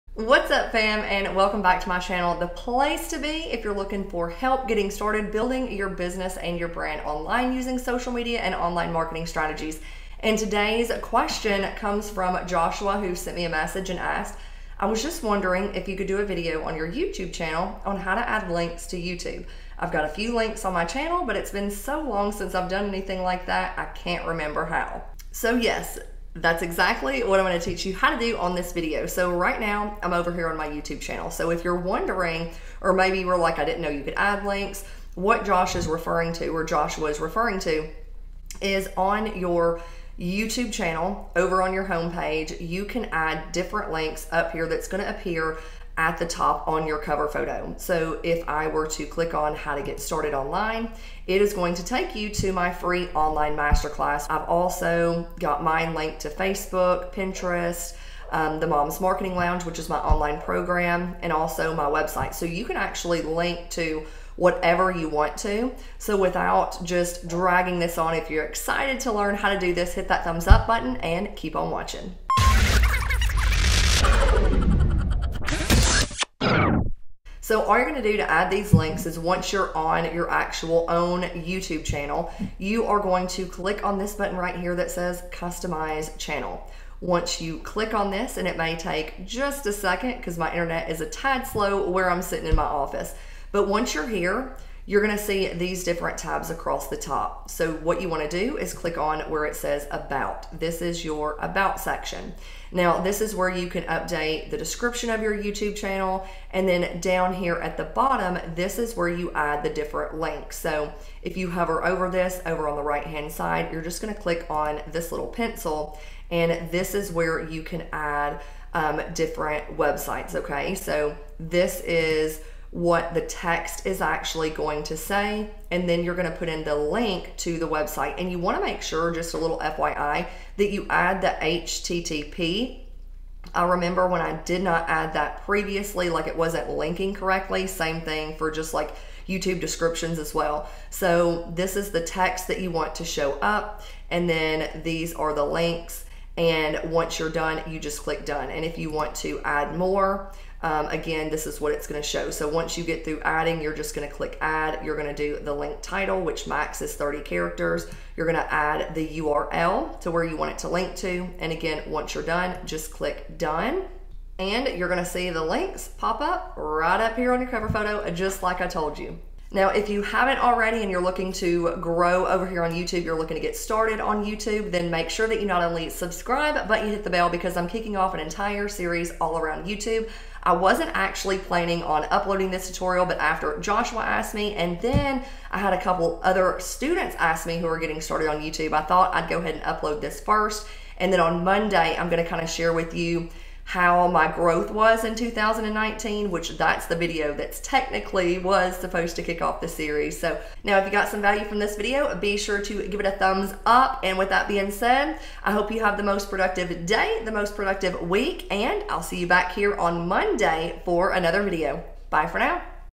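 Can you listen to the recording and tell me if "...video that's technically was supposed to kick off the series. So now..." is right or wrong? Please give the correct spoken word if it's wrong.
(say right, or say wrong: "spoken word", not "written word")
right.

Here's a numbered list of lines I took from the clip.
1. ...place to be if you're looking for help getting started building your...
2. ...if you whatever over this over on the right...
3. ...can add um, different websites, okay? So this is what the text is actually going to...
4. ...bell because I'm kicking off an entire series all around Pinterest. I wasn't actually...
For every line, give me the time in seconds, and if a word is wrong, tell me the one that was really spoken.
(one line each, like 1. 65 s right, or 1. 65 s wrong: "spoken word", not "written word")
1. 2 s right
2. 111 s wrong: "hover", not "whatever"
3. 117 s right
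4. 177 s wrong: "YouTube", not "Pinterest".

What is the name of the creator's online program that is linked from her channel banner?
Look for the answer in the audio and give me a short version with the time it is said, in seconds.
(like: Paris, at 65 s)
the Mom's Marketing Lounge, at 58 s.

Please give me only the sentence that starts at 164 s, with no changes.
And you're gonna see the links pop up right up here on your cover photo, just like I told you.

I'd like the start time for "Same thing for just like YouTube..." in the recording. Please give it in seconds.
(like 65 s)
137 s.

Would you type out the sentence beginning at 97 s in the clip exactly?
So what you wanna do is click on where it says about.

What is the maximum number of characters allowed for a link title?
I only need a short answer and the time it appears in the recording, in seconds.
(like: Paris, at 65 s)
30, at 156 s.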